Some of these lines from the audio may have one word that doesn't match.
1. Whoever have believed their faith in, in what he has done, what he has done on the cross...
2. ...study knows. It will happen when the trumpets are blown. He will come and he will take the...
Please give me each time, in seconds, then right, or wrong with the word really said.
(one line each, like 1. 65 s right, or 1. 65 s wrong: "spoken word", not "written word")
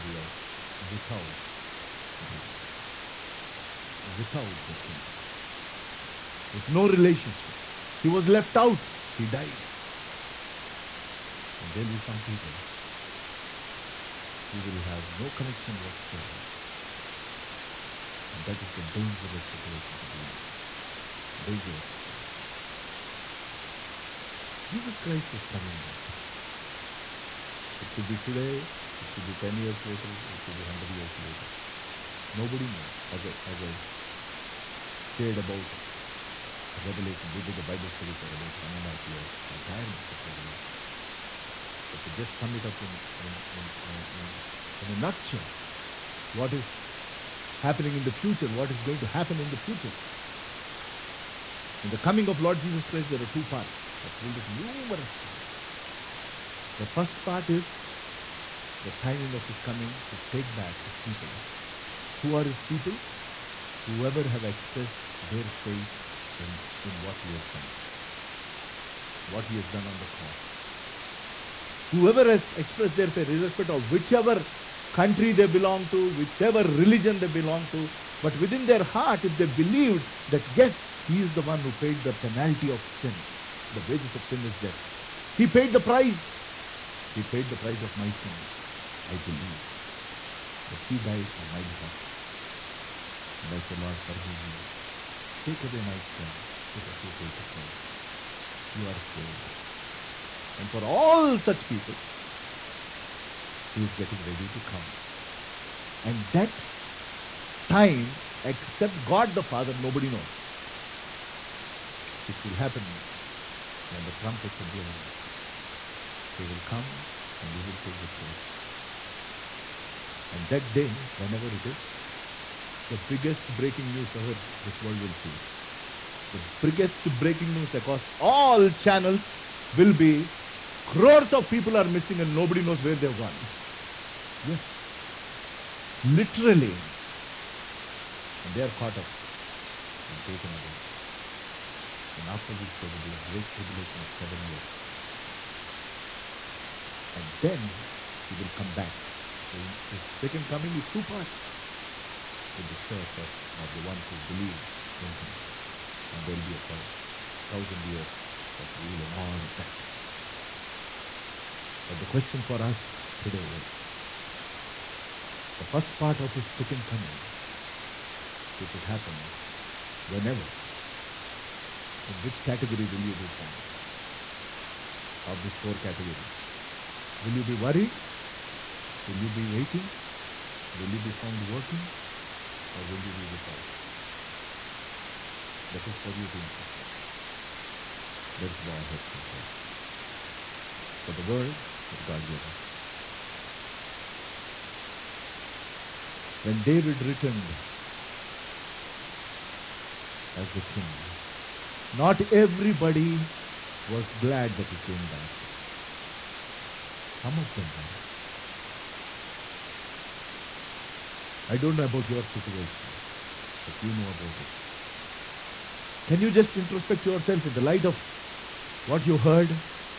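1. 63 s wrong: "expressed", not "believed"
2. 109 s wrong: "nobody", not "study".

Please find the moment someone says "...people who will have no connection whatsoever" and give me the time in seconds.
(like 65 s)
12 s.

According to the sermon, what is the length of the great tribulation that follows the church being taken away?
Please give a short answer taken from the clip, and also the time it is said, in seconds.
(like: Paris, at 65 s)
7 years, at 144 s.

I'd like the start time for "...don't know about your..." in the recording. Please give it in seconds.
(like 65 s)
211 s.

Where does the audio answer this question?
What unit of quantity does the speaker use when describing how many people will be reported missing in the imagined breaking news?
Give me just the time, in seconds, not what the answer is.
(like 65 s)
130 s.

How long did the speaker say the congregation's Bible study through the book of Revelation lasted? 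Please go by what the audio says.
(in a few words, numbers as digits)
1.5 years.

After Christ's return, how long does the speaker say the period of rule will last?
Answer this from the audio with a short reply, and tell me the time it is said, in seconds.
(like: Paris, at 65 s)
1000 years, at 156 s.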